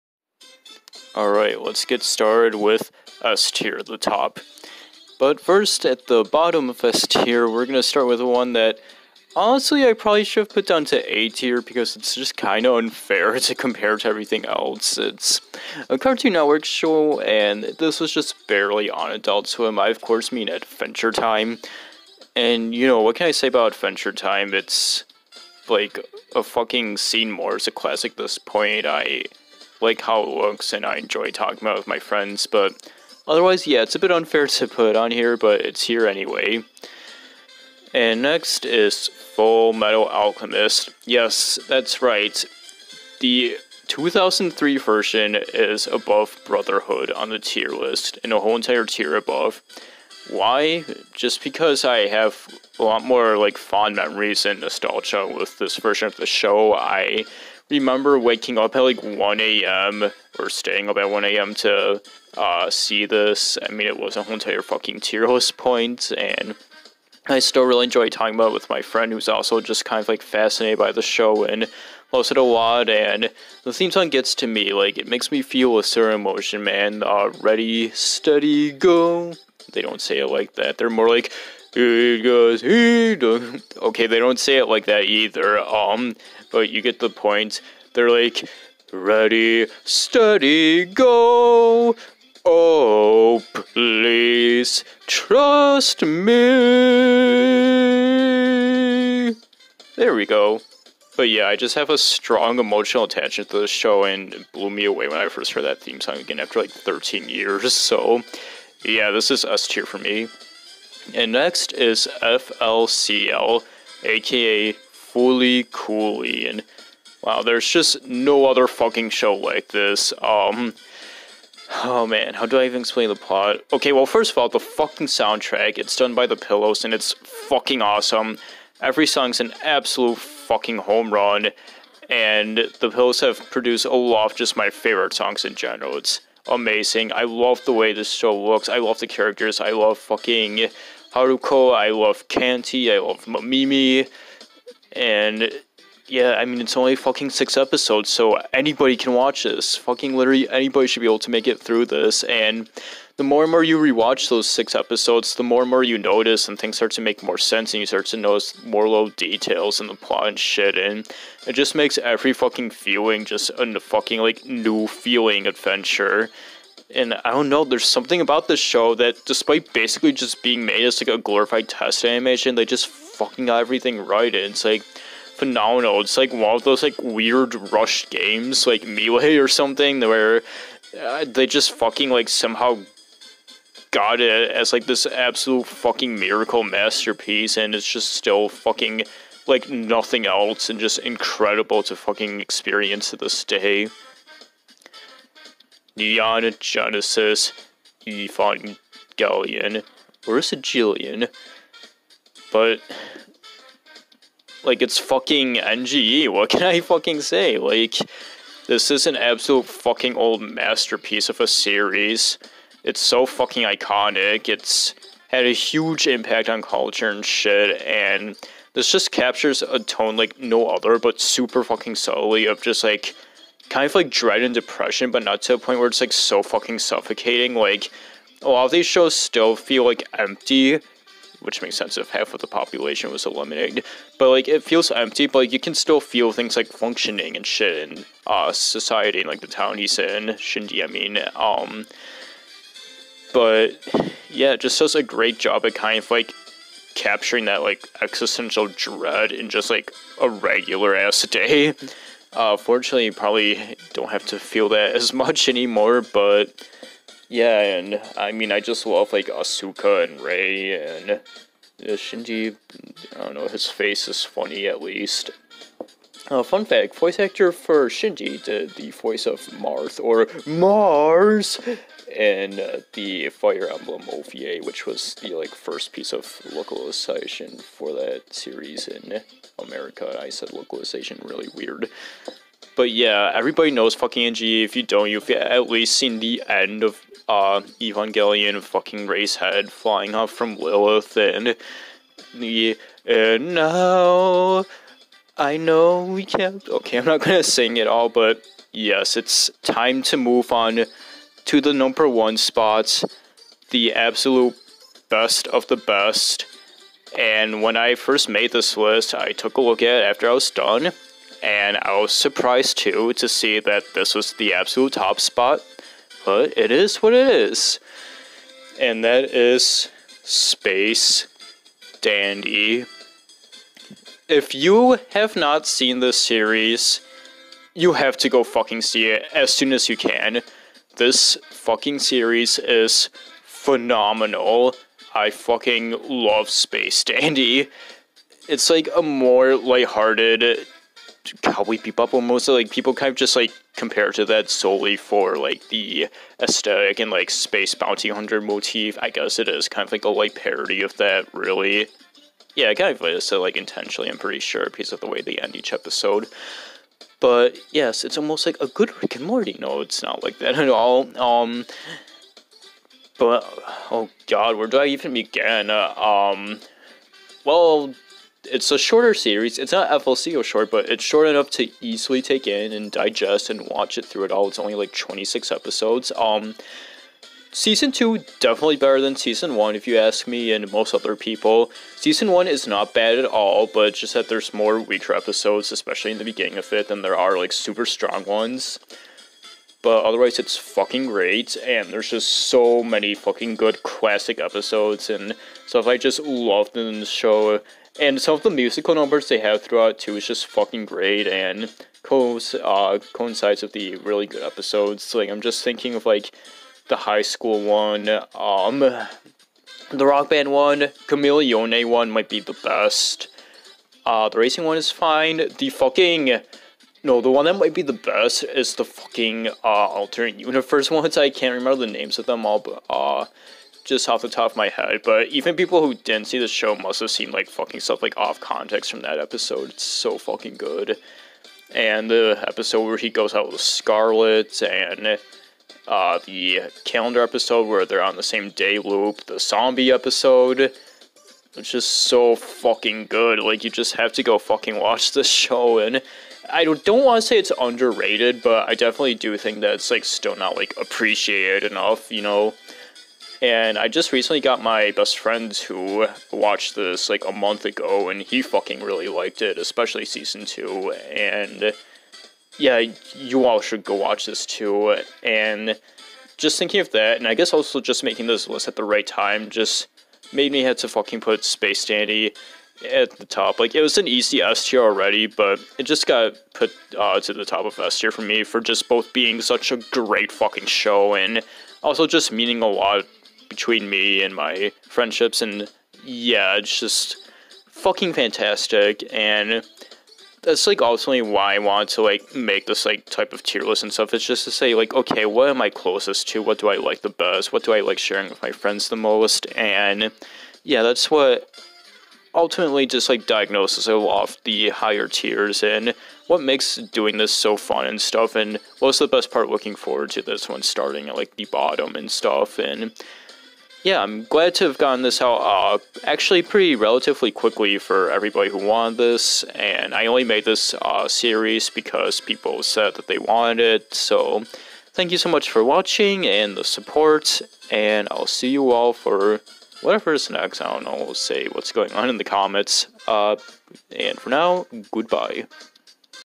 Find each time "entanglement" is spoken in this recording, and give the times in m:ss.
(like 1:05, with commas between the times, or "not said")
not said.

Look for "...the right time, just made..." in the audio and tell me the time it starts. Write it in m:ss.
7:48.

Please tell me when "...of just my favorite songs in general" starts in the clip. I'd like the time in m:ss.
2:14.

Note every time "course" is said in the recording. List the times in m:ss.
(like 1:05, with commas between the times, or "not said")
0:19.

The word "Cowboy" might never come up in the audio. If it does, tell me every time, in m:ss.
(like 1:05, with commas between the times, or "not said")
5:41.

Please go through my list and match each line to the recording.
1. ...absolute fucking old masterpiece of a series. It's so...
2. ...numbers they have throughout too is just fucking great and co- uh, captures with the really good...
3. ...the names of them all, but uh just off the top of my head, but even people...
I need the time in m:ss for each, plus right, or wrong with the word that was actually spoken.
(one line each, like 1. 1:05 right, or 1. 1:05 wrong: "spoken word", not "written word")
1. 3:29 right
2. 6:38 wrong: "coincides", not "captures"
3. 7:01 right.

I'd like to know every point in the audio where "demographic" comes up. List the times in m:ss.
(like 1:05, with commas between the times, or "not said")
not said.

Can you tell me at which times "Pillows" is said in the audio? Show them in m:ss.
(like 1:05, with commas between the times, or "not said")
2:06, 2:12.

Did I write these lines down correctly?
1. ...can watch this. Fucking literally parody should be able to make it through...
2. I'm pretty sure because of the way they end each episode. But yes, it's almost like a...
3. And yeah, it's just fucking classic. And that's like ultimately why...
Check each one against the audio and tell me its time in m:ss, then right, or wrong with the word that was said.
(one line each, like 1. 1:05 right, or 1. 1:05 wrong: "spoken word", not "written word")
1. 2:28 wrong: "anybody", not "parody"
2. 5:54 right
3. 8:05 wrong: "fantastic", not "classic".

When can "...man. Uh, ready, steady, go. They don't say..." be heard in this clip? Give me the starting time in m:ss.
1:16.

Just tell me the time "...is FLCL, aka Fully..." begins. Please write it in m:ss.
1:51.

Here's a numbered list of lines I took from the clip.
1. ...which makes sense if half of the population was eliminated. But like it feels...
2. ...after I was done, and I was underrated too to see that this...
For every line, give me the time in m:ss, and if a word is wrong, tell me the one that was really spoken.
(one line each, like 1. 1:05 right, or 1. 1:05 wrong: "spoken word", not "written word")
1. 3:51 right
2. 5:10 wrong: "surprised", not "underrated".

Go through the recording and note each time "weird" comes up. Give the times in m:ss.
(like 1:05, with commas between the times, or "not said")
2:57, 4:41.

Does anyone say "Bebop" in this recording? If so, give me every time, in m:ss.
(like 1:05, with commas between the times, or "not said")
5:41.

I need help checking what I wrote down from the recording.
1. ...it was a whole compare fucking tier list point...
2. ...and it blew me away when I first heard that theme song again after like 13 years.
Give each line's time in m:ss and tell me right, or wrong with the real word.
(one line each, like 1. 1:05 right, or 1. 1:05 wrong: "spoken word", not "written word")
1. 1:03 wrong: "entire", not "compare"
2. 1:44 right.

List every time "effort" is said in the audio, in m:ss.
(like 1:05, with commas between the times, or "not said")
not said.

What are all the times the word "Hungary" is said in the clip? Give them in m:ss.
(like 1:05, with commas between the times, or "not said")
not said.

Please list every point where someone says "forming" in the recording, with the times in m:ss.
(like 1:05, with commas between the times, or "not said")
not said.